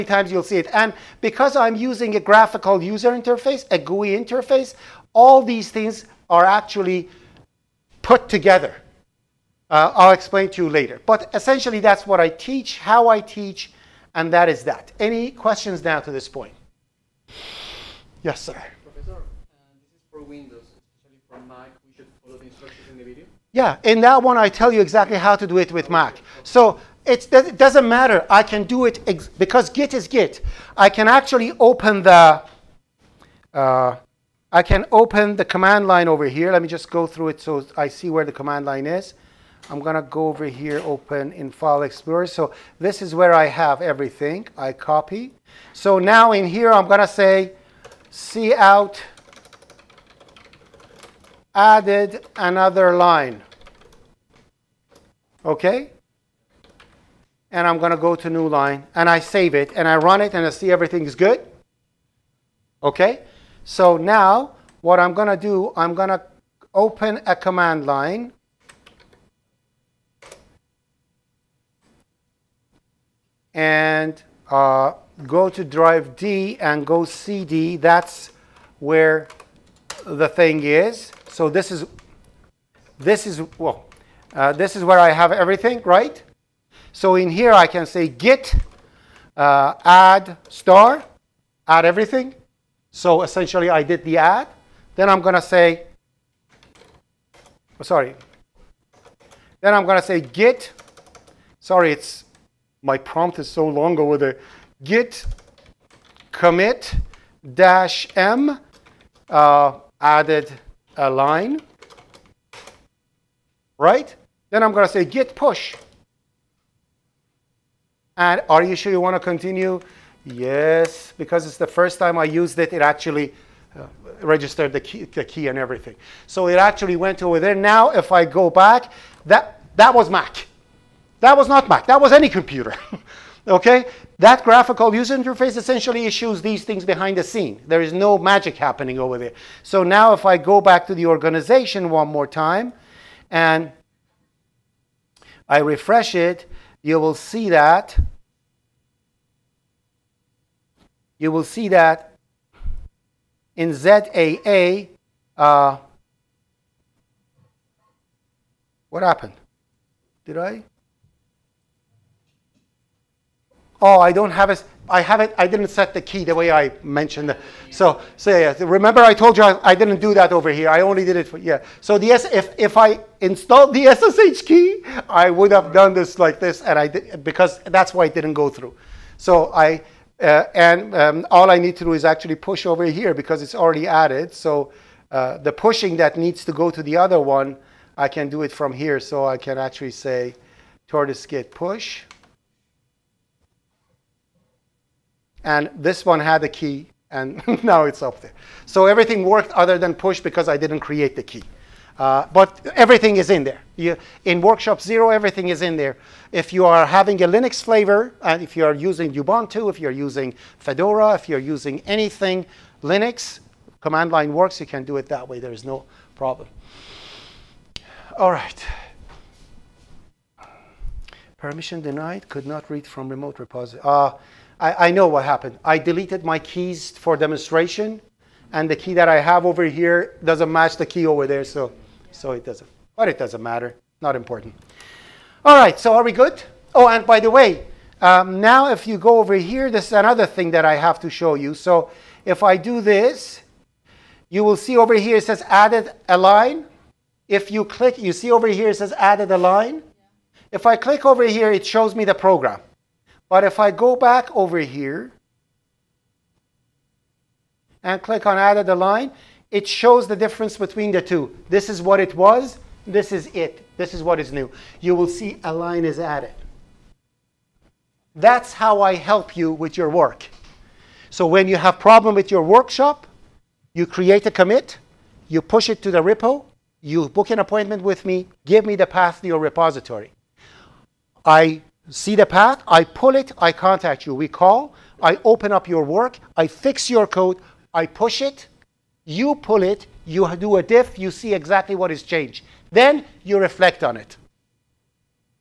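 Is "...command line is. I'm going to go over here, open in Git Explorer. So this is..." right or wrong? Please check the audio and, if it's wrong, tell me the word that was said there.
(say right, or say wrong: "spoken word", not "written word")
wrong: "File", not "Git".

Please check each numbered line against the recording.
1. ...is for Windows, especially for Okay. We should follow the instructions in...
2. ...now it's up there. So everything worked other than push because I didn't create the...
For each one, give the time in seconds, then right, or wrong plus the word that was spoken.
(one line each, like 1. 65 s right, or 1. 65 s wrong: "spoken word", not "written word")
1. 19 s wrong: "Mac", not "Okay"
2. 197 s right.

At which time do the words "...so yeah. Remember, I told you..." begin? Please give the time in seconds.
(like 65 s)
168 s.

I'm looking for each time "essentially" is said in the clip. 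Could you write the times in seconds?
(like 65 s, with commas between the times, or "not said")
11 s, 93 s, 135 s.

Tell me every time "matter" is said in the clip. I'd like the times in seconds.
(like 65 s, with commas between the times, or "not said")
27 s, 233 s.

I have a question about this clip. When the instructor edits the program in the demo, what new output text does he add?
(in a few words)
added another line.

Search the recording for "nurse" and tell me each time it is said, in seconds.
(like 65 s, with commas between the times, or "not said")
not said.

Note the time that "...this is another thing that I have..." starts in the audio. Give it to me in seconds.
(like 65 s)
239 s.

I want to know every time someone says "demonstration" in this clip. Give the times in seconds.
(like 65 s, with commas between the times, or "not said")
227 s.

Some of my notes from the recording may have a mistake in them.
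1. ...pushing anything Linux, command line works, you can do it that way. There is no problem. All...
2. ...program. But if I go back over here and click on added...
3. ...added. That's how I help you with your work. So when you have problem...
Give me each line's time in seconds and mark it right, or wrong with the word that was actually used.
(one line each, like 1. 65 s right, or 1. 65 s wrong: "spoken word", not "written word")
1. 211 s wrong: "using", not "pushing"
2. 252 s right
3. 265 s right.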